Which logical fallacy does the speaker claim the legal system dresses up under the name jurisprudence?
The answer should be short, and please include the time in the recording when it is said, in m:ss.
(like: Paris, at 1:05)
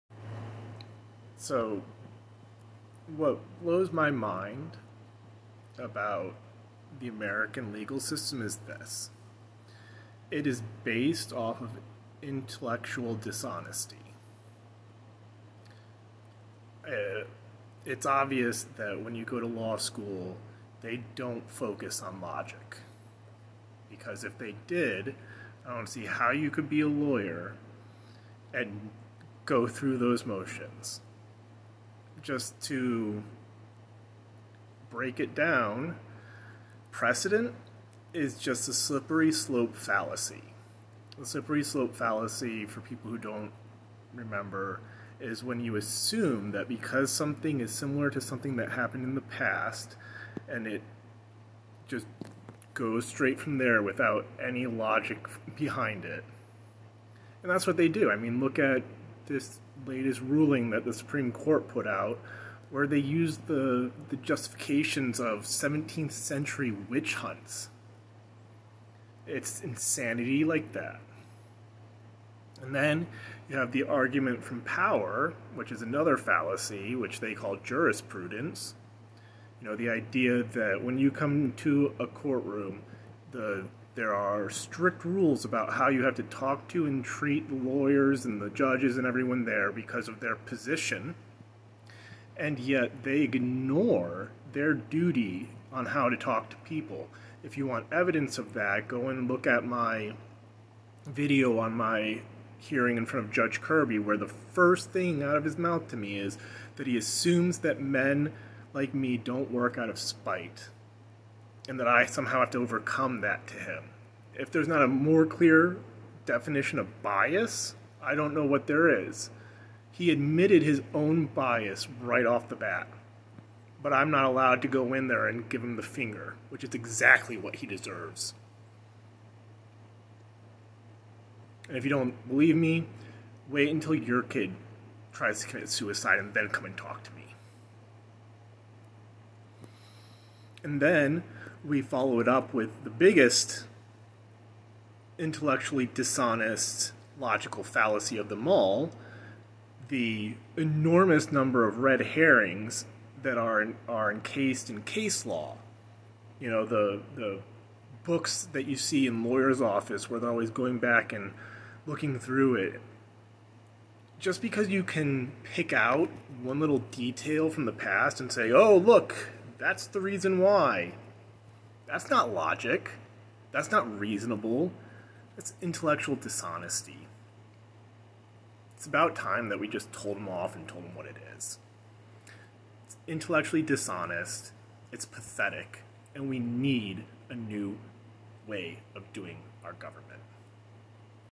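argument from power, at 1:13.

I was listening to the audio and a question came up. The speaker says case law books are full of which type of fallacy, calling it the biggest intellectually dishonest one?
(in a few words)
red herrings.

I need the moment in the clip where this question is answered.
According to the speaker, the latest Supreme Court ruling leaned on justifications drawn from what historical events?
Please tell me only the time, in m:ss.
1:05.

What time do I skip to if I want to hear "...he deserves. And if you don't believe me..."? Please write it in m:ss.
2:07.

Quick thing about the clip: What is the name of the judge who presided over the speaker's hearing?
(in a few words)
Judge Kirby.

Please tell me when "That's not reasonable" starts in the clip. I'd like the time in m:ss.
2:53.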